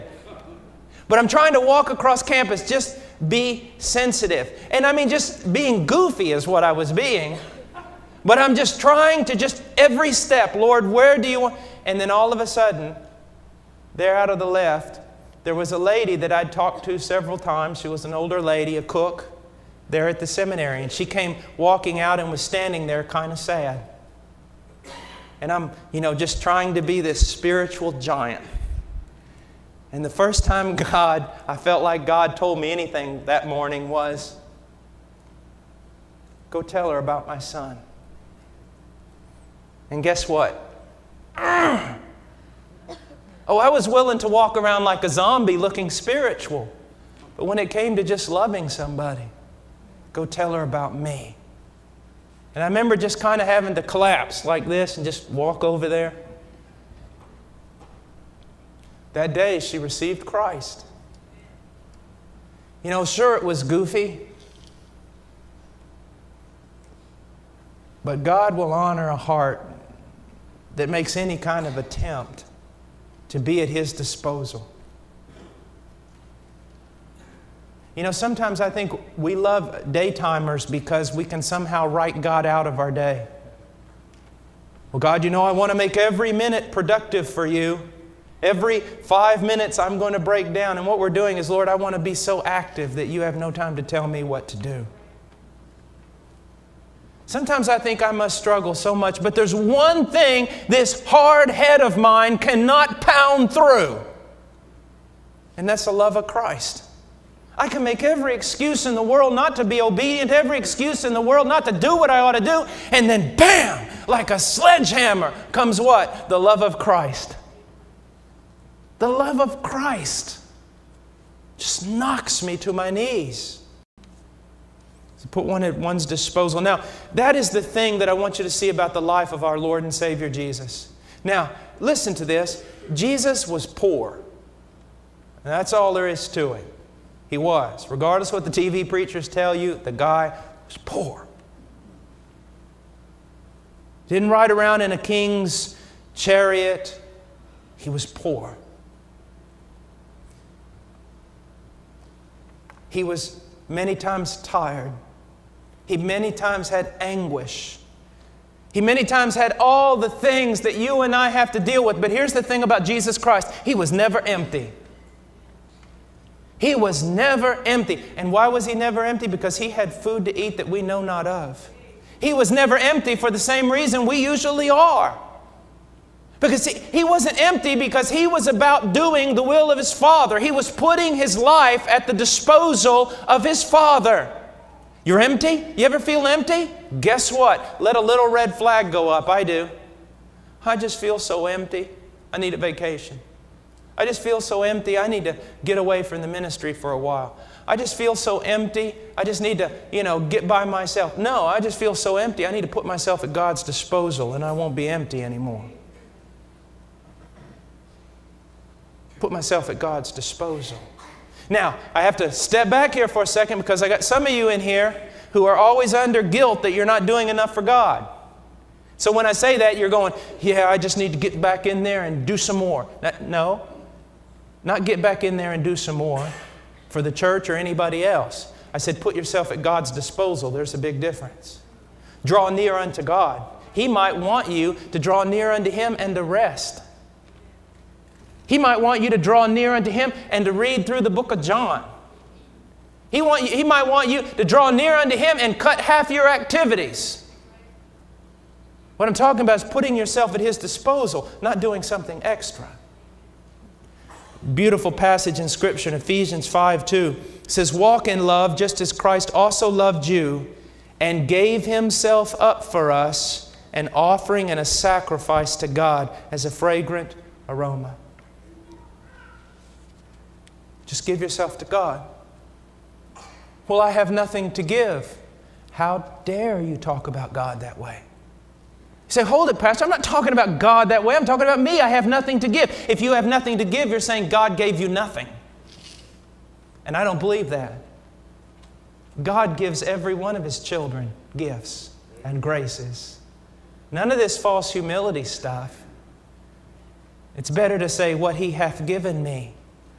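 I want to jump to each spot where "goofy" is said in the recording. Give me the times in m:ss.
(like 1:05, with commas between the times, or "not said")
0:05, 1:03.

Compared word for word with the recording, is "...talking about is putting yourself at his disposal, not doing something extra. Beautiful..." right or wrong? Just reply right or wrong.
right.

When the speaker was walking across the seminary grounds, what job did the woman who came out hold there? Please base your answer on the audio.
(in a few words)
Cook.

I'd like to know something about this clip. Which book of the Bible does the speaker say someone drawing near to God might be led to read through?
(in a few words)
John.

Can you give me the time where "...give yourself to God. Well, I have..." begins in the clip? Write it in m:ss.
4:31.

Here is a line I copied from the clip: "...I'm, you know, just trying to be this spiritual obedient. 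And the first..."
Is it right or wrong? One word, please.
wrong.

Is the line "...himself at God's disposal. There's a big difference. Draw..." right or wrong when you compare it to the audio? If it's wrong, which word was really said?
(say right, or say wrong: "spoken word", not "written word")
wrong: "yourself", not "himself".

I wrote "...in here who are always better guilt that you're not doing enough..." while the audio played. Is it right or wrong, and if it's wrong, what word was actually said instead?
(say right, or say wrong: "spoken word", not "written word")
wrong: "under", not "better".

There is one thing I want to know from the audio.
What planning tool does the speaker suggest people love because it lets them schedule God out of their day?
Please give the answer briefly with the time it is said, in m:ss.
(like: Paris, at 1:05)
Daytimers, at 1:19.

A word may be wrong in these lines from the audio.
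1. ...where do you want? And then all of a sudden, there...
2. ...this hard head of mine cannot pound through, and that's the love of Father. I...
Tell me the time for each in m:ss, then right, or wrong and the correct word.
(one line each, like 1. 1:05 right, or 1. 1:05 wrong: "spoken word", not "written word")
1. 0:10 right
2. 1:40 wrong: "Christ", not "Father".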